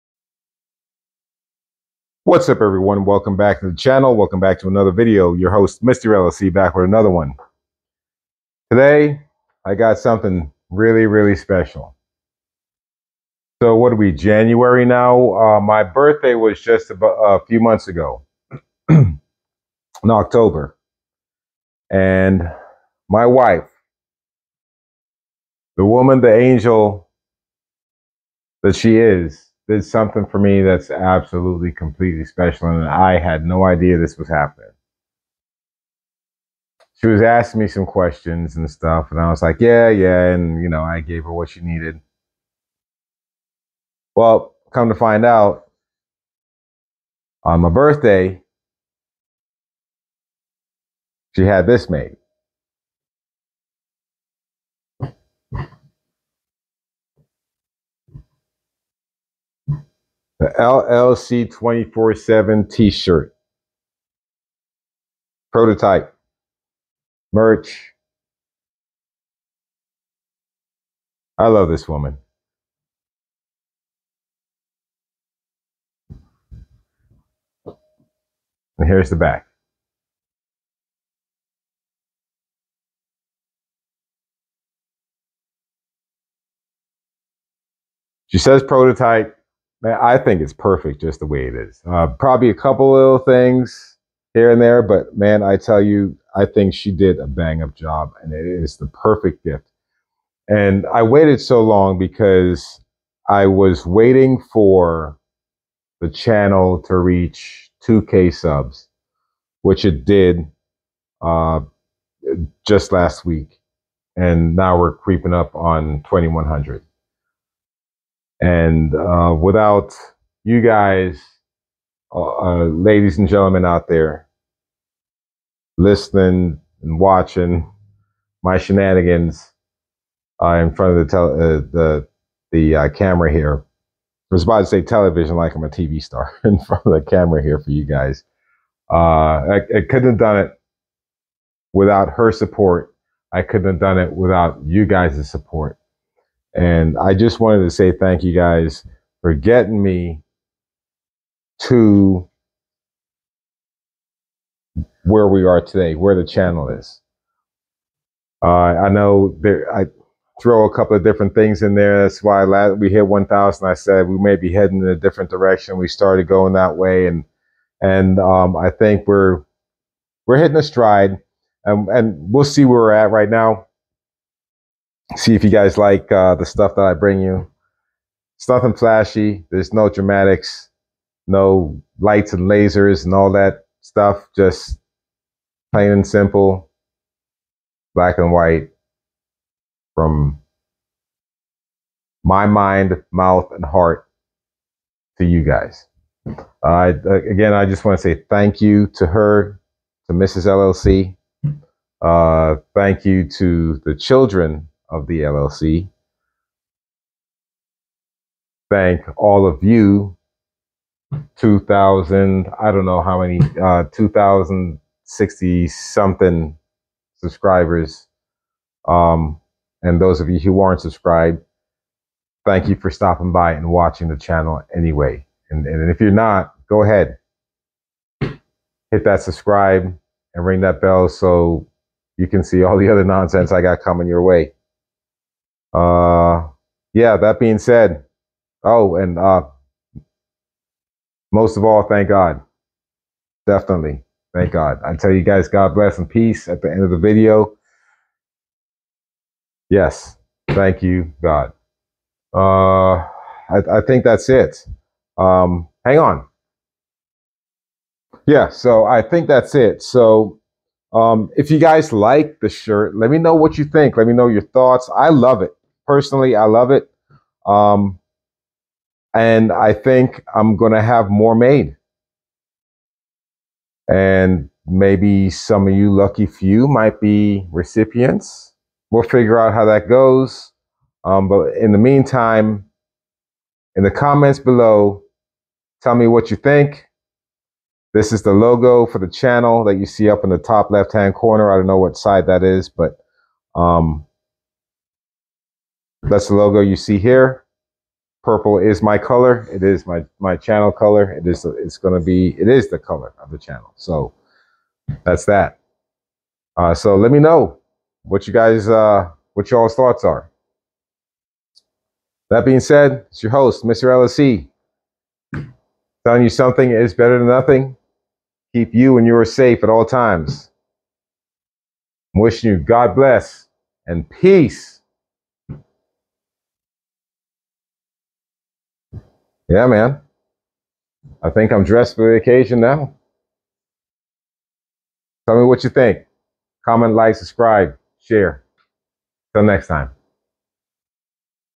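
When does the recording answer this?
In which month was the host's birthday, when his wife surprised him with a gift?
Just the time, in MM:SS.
00:20.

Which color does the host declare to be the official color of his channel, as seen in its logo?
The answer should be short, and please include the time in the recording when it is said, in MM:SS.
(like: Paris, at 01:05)
Purple, at 04:58.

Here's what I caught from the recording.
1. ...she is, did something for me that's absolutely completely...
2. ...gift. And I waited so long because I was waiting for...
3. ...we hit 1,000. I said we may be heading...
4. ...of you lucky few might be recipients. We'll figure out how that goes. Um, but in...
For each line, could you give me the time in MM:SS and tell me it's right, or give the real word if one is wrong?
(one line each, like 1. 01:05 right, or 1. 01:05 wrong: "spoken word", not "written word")
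1. 00:28 right
2. 01:39 right
3. 02:42 right
4. 04:35 right.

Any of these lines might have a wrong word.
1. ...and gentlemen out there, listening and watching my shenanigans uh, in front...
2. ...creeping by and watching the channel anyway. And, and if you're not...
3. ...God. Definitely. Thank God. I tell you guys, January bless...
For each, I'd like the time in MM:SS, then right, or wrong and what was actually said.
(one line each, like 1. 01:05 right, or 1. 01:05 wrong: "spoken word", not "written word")
1. 02:03 right
2. 03:42 wrong: "stopping", not "creeping"
3. 04:02 wrong: "God", not "January".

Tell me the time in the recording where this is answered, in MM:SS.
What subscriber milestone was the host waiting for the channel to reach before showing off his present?
01:47.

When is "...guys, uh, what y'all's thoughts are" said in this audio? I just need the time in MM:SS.
05:08.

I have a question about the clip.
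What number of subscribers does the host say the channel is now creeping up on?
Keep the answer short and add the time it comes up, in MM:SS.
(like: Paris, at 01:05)
2,100, at 01:56.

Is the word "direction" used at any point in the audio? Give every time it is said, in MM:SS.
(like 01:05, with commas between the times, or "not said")
02:45.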